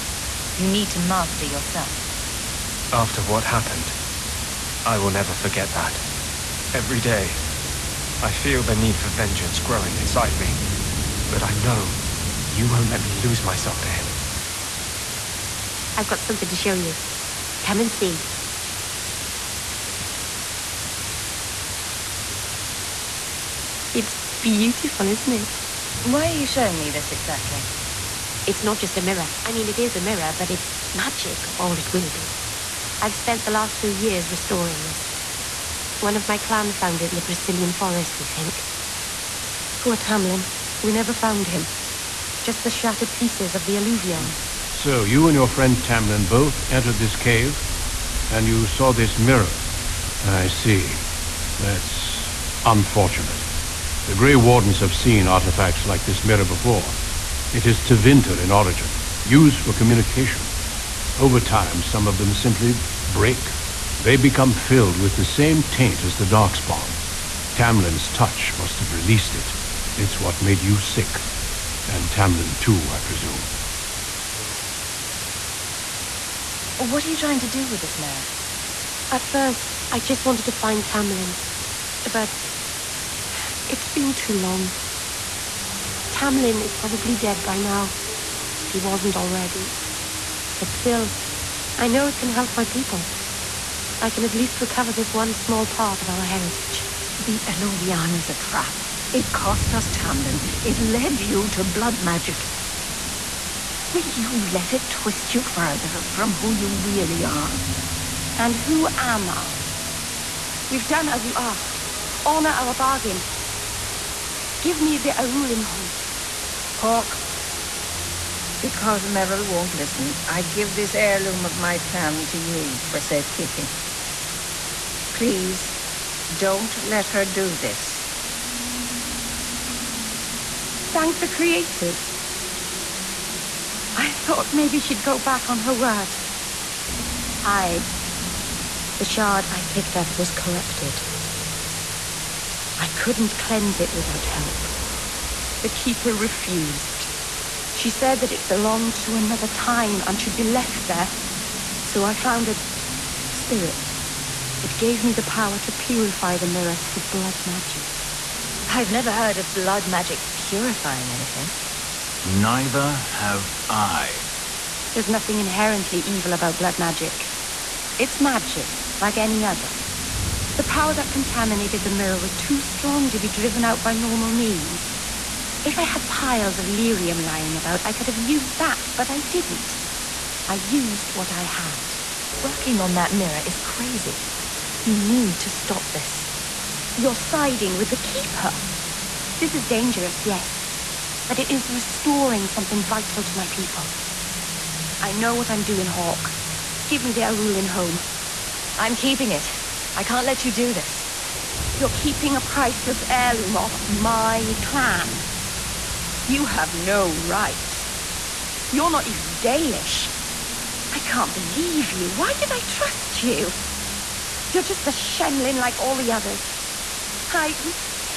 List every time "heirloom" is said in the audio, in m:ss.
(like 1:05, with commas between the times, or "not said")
2:00, 3:23.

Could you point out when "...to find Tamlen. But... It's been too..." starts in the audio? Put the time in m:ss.
1:20.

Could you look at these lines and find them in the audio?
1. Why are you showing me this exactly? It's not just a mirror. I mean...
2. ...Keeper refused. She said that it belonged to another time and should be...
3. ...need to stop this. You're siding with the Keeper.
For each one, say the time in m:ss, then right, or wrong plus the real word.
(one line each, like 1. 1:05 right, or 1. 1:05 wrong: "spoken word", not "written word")
1. 0:26 right
2. 2:25 right
3. 3:04 right.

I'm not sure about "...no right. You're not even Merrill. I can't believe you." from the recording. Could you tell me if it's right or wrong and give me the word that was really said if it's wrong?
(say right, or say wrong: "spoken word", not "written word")
wrong: "Dalish", not "Merrill".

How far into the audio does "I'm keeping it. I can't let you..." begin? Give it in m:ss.
3:18.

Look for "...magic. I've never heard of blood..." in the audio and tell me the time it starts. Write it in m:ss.
2:37.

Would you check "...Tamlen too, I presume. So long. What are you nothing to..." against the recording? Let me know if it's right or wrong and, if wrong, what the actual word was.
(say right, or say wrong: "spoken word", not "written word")
wrong: "trying", not "nothing".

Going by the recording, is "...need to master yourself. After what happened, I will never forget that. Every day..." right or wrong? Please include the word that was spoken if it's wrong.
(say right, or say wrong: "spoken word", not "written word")
right.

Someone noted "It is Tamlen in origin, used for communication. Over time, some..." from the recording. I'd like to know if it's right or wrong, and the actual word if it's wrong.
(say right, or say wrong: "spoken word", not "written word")
wrong: "Tevinter", not "Tamlen".